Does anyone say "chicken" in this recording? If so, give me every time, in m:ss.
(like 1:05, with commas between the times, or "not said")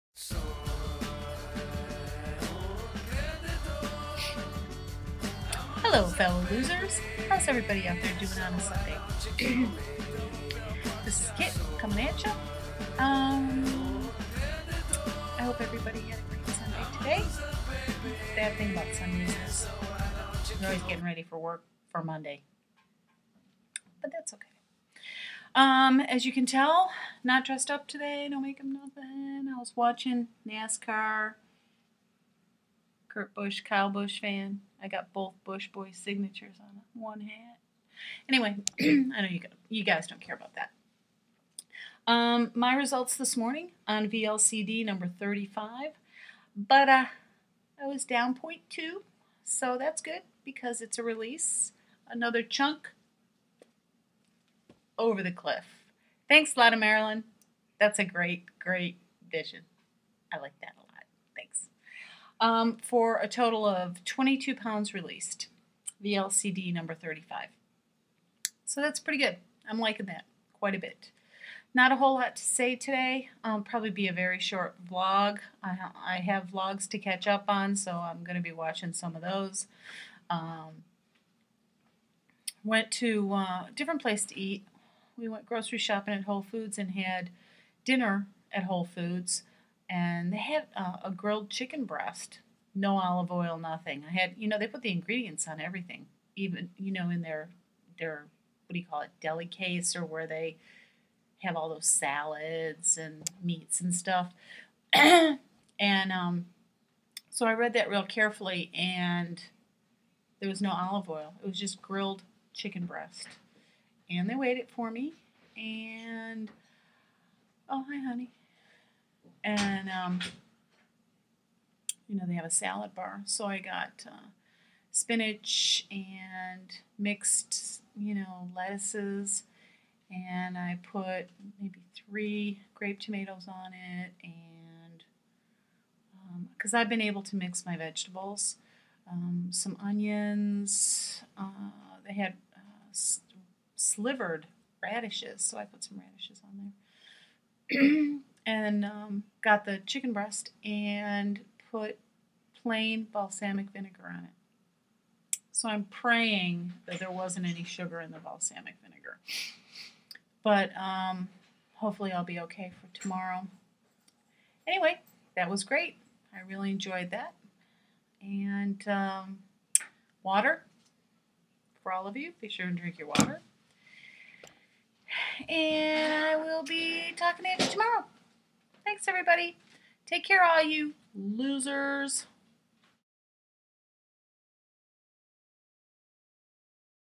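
1:31, 1:52, 2:29.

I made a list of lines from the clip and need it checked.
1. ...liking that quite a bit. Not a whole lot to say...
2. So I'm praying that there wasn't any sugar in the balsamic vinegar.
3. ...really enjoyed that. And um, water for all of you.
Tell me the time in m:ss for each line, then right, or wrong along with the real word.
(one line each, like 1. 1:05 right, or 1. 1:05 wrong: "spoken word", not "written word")
1. 1:09 right
2. 2:35 right
3. 2:46 right.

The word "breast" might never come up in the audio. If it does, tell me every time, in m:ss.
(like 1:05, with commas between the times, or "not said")
1:31, 1:52, 2:30.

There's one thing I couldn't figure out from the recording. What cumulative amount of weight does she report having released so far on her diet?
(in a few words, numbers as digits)
22 pounds.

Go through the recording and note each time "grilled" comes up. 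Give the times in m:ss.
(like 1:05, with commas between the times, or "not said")
1:31, 1:51.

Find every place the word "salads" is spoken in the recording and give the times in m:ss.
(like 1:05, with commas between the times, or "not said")
1:41, 2:02.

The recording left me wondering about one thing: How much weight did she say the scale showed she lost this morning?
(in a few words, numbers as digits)
0.2.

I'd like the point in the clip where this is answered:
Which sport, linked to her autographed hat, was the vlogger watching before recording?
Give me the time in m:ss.
0:30.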